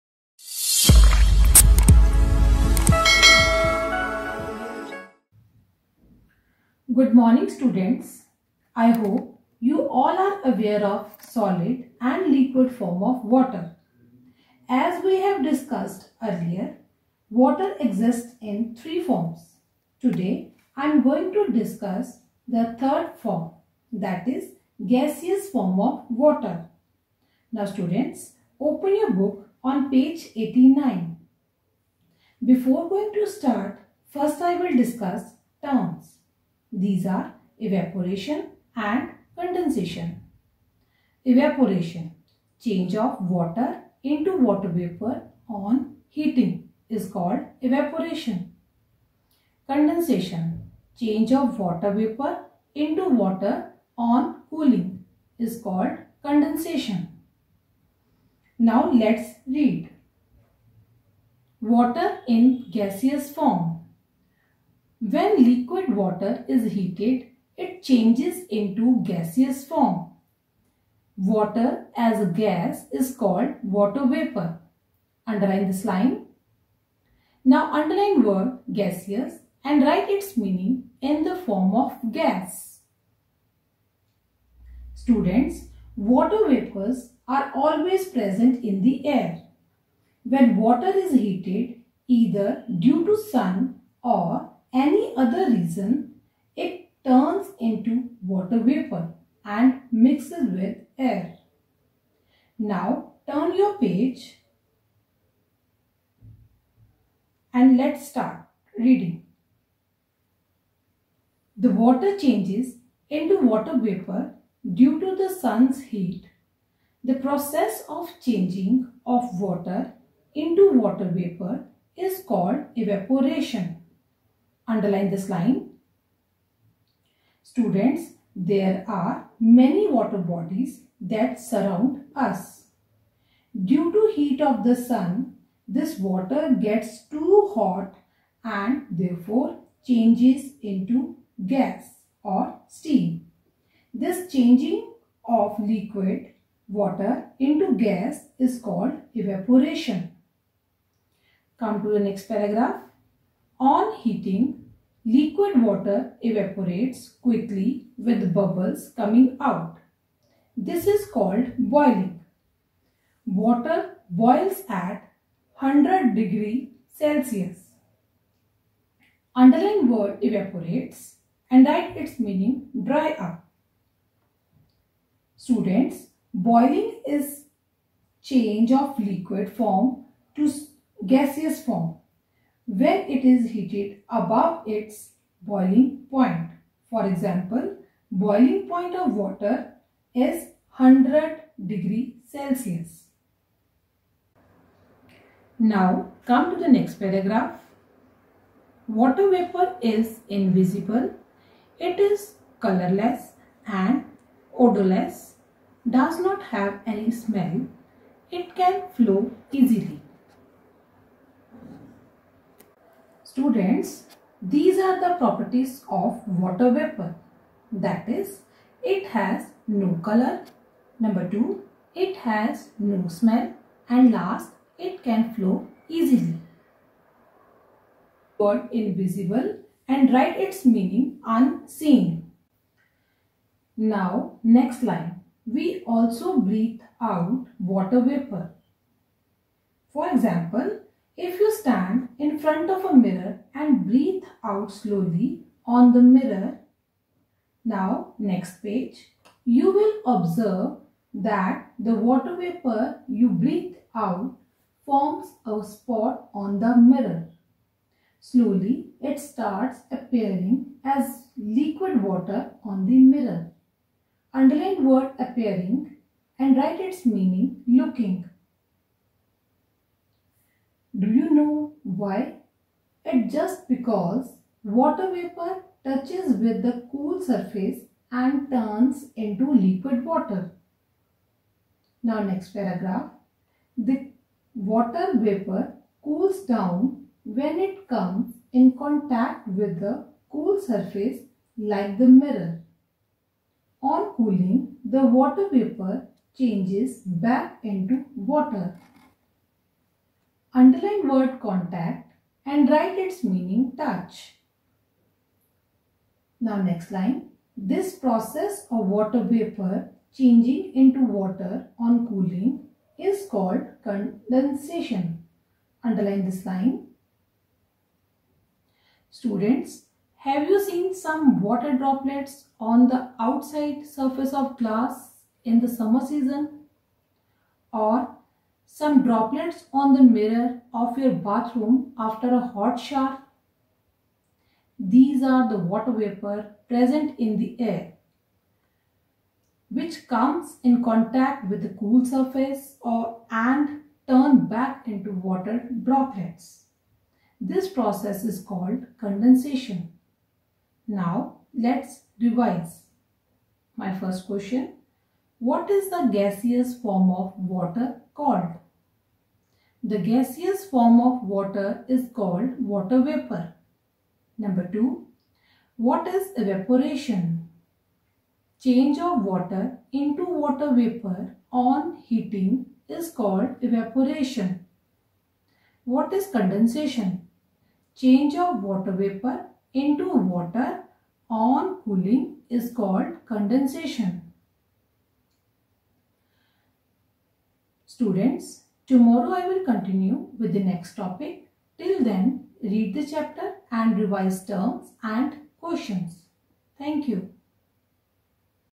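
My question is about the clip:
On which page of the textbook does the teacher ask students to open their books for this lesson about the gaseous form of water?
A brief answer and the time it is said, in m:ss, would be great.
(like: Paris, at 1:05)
89, at 0:29.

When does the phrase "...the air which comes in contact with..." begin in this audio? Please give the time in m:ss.
5:37.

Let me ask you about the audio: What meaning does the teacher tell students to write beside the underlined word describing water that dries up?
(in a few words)
dry up.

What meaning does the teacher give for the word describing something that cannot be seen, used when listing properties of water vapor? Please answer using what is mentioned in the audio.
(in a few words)
unseen.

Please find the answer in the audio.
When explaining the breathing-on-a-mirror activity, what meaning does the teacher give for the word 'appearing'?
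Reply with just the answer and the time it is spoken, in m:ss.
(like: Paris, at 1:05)
looking, at 4:27.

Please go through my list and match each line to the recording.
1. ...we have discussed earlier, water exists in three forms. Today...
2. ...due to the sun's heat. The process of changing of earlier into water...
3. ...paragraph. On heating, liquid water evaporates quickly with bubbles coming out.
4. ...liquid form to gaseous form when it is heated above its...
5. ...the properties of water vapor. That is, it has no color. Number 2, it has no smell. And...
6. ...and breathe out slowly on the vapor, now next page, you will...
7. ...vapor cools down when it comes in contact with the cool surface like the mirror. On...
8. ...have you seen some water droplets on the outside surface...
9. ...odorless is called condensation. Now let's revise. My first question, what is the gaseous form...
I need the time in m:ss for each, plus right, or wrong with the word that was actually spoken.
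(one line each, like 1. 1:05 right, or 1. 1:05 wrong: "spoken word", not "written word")
1. 0:15 right
2. 1:54 wrong: "water", not "earlier"
3. 2:32 right
4. 2:58 right
5. 3:34 right
6. 4:03 wrong: "mirror", not "vapor"
7. 4:45 right
8. 5:20 right
9. 5:47 wrong: "process", not "odorless".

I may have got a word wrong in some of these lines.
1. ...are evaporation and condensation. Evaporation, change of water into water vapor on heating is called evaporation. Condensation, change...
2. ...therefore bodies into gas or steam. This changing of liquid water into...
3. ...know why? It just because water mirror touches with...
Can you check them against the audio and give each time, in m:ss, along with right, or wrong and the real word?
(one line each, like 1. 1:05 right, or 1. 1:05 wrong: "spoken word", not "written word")
1. 0:37 right
2. 2:18 wrong: "changes", not "bodies"
3. 4:31 wrong: "vapor", not "mirror".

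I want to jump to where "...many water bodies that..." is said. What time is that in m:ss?
2:09.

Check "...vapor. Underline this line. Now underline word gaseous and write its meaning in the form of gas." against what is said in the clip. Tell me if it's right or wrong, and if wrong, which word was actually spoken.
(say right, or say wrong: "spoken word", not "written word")
right.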